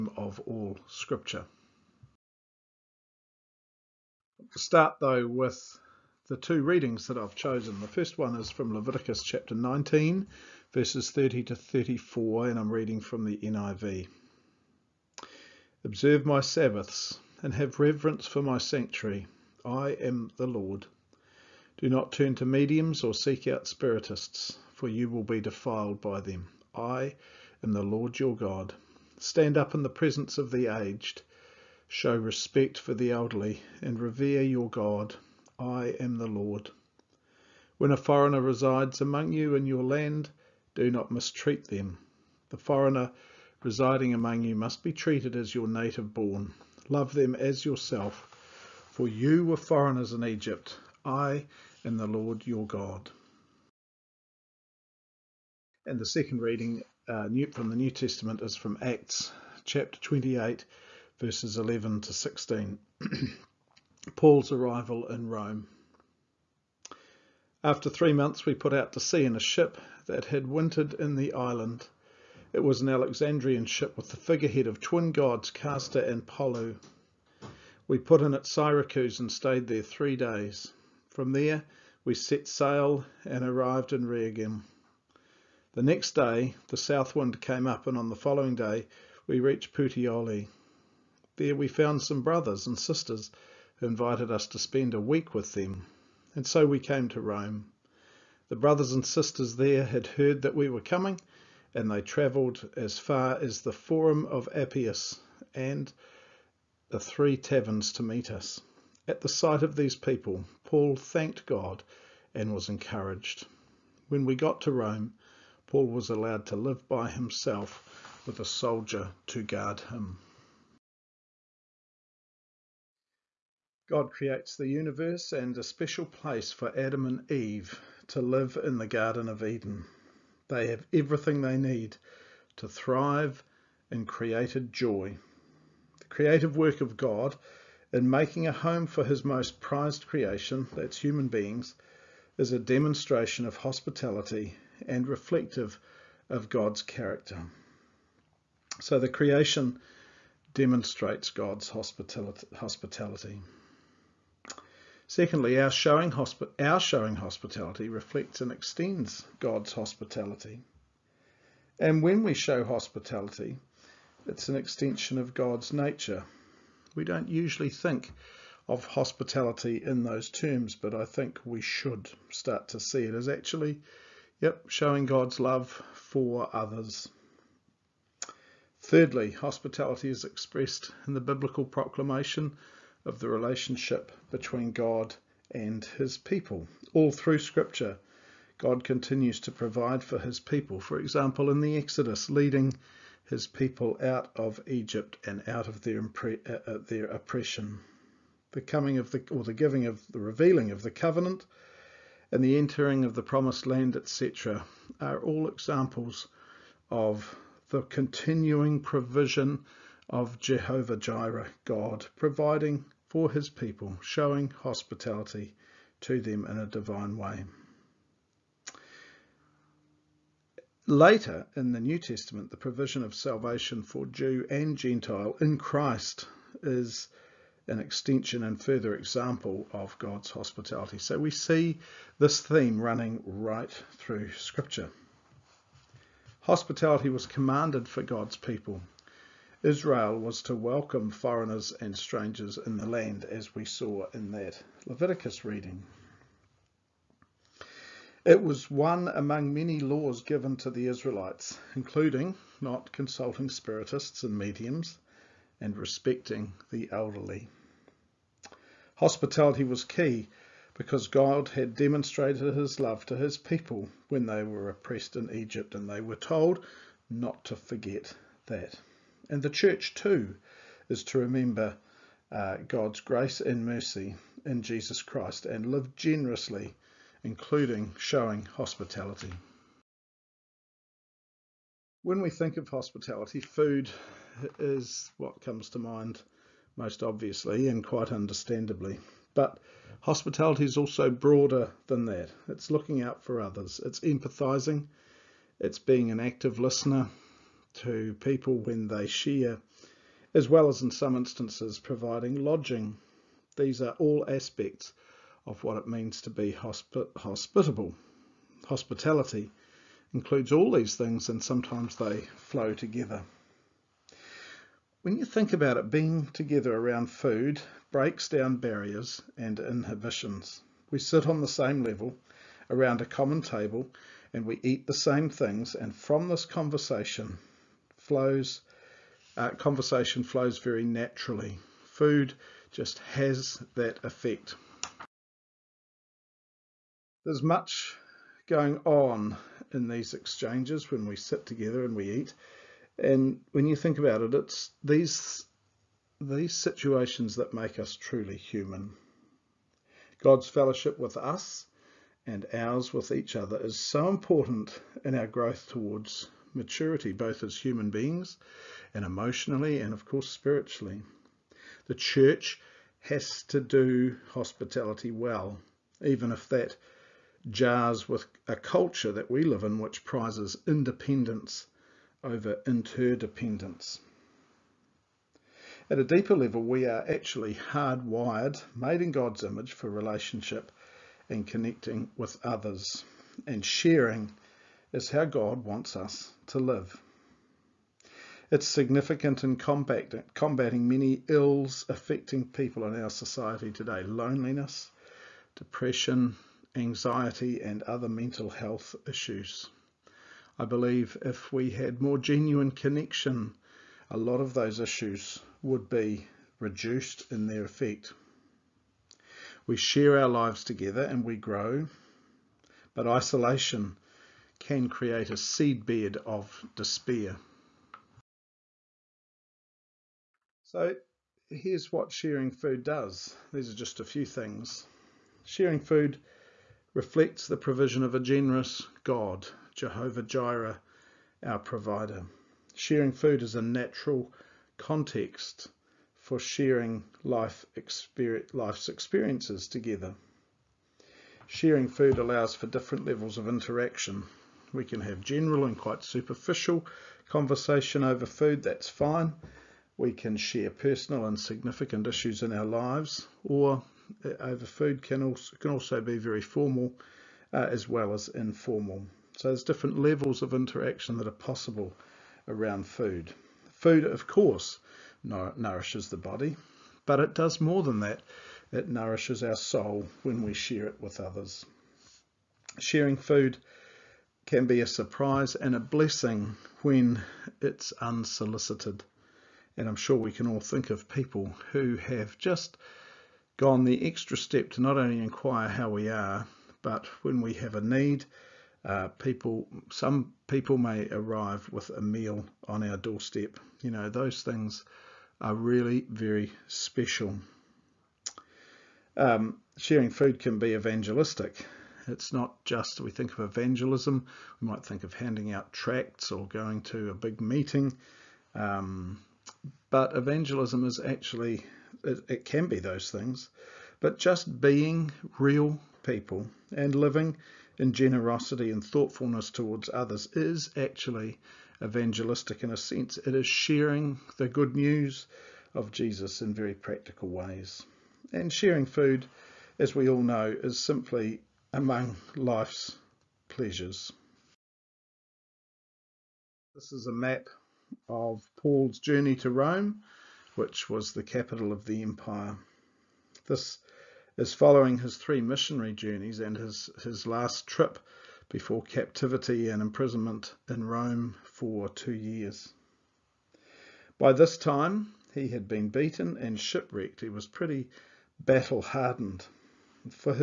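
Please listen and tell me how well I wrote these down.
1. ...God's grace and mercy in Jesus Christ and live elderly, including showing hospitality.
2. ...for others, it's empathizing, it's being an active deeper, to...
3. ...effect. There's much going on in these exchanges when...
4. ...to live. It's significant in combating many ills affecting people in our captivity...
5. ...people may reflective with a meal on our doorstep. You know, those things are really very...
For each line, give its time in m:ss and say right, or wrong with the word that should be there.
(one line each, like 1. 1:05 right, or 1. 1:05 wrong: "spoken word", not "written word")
1. 4:32 wrong: "generously", not "elderly"
2. 4:53 wrong: "listener", not "deeper"
3. 5:34 right
4. 6:26 wrong: "society", not "captivity"
5. 8:10 wrong: "arrive", not "reflective".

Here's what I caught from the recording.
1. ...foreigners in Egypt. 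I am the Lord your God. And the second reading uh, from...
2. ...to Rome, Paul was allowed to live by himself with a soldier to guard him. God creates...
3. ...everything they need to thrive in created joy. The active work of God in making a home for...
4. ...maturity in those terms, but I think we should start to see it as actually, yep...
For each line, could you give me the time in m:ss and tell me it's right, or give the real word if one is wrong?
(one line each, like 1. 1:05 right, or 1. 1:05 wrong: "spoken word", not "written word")
1. 0:49 right
2. 1:54 right
3. 2:10 wrong: "creative", not "active"
4. 2:48 wrong: "hospitality", not "maturity".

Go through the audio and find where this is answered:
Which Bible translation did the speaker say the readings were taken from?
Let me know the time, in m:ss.
0:13.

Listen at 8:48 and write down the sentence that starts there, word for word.
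And sharing food, as we all know, is simply among life's pleasures.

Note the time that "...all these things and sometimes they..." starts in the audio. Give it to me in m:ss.
5:10.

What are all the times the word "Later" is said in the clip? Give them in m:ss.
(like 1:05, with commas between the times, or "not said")
3:40.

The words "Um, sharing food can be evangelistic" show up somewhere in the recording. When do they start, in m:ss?
8:19.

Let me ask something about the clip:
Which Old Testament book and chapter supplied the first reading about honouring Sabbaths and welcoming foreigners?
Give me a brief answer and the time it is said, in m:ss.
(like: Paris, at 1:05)
Leviticus 19, at 0:08.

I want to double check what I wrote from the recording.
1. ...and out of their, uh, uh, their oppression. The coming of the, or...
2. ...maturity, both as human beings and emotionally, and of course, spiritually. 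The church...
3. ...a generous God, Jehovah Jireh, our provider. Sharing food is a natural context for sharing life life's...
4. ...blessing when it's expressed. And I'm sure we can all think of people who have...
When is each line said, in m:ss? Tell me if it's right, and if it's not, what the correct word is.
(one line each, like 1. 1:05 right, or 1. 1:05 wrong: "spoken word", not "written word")
1. 3:15 right
2. 5:56 right
3. 7:08 right
4. 7:55 wrong: "unsolicited", not "expressed".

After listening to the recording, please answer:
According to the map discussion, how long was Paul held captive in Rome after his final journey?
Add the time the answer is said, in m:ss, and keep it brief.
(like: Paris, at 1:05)
2 years, at 9:11.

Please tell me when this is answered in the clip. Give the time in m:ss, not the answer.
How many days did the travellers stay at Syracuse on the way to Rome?
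1:19.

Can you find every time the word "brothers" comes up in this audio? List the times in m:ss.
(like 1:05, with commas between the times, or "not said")
1:32, 1:38.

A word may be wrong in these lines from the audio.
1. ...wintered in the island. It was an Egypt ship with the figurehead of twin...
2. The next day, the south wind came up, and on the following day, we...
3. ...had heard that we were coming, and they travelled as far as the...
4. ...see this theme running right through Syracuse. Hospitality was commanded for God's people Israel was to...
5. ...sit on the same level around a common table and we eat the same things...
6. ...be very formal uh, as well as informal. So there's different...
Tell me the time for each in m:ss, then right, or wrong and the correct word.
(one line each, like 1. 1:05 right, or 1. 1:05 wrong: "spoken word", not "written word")
1. 1:10 wrong: "Alexandrian", not "Egypt"
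2. 1:25 right
3. 1:39 right
4. 3:51 wrong: "Scripture", not "Syracuse"
5. 5:20 right
6. 7:36 right.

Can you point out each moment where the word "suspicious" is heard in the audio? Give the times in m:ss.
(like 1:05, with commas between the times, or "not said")
not said.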